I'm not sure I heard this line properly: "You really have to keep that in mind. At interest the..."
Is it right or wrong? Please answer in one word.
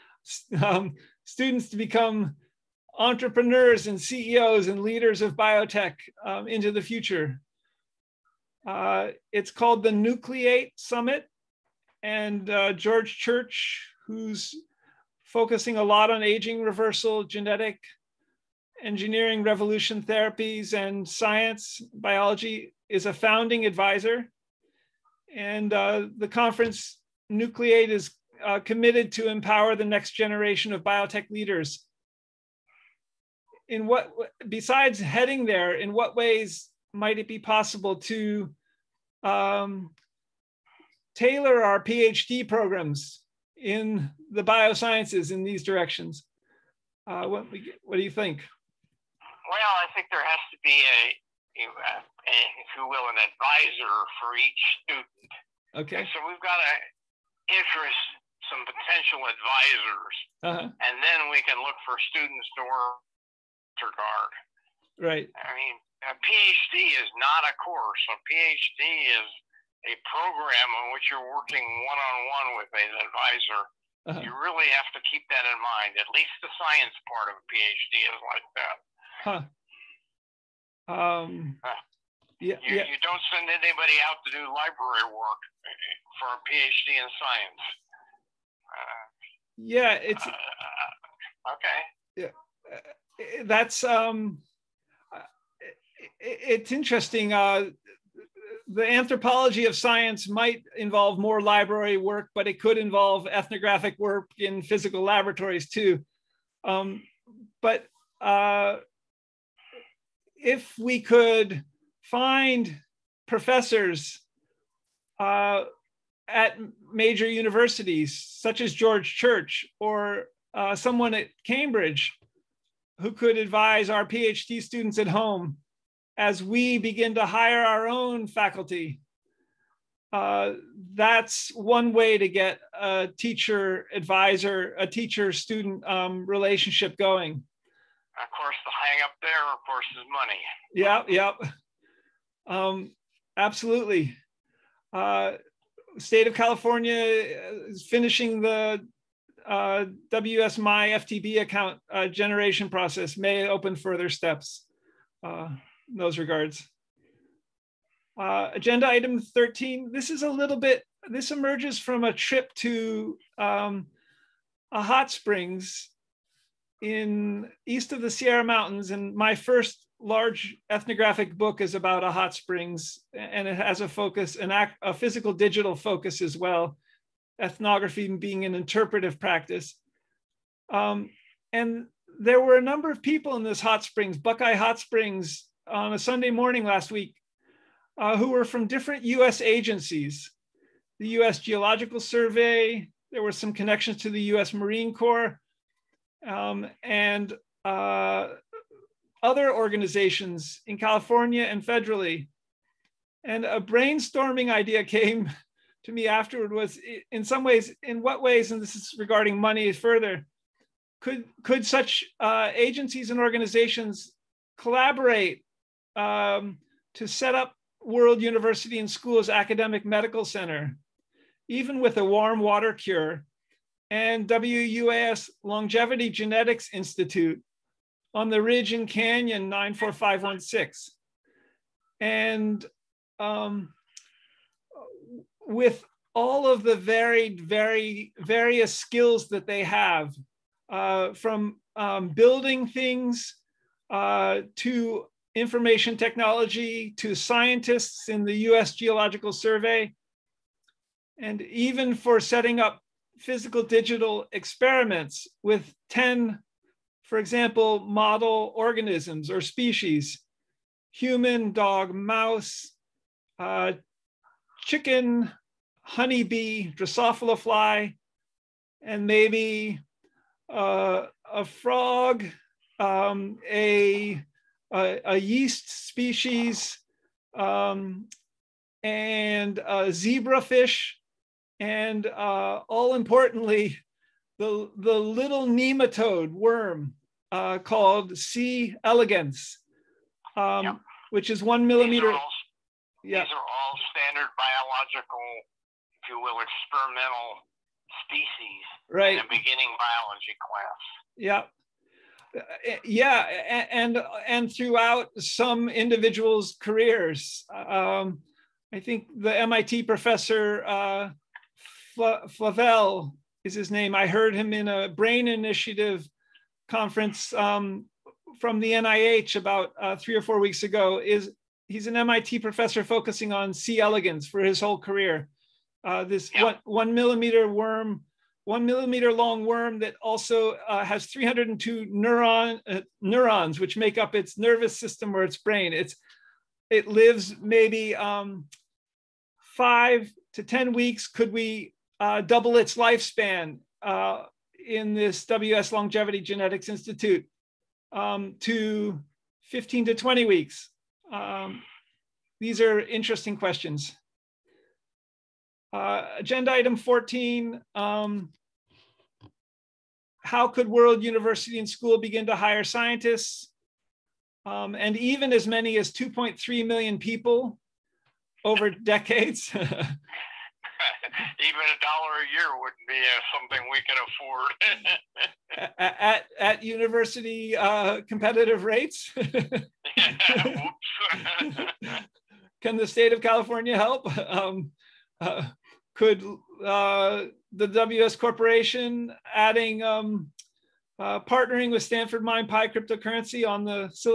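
wrong.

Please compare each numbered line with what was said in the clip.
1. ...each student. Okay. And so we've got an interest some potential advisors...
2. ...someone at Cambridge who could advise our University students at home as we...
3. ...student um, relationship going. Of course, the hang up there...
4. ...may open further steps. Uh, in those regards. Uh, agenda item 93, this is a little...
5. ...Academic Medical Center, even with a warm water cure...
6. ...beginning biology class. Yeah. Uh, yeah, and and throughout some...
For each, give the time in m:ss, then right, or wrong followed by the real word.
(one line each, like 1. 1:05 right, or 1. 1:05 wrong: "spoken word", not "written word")
1. 0:54 right
2. 2:00 wrong: "PhD", not "University"
3. 2:15 right
4. 2:33 wrong: "13", not "93"
5. 3:39 right
6. 4:59 right.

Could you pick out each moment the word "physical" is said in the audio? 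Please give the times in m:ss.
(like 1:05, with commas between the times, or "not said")
1:44, 2:54, 4:13.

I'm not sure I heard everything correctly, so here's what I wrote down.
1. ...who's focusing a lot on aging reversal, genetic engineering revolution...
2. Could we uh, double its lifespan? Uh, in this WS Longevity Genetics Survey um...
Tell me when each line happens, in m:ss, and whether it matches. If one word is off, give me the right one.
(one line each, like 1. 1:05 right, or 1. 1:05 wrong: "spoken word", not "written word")
1. 0:14 right
2. 5:41 wrong: "Institute", not "Survey".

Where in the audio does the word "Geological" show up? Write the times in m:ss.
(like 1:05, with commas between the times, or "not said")
3:11, 4:08.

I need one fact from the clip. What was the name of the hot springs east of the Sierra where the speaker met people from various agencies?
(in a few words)
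Buckeye Hot Springs.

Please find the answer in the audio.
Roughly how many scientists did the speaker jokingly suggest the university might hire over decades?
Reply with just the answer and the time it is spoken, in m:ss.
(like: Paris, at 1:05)
2.3 million, at 6:05.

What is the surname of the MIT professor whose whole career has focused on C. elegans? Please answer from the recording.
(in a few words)
Flavell.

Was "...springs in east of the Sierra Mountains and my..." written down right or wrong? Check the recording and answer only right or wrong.
right.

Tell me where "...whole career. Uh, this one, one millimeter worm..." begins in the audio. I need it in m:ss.
5:24.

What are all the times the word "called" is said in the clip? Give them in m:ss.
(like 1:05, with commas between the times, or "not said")
0:09, 4:47.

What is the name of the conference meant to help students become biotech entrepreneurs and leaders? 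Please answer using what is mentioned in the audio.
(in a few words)
Nucleate Summit.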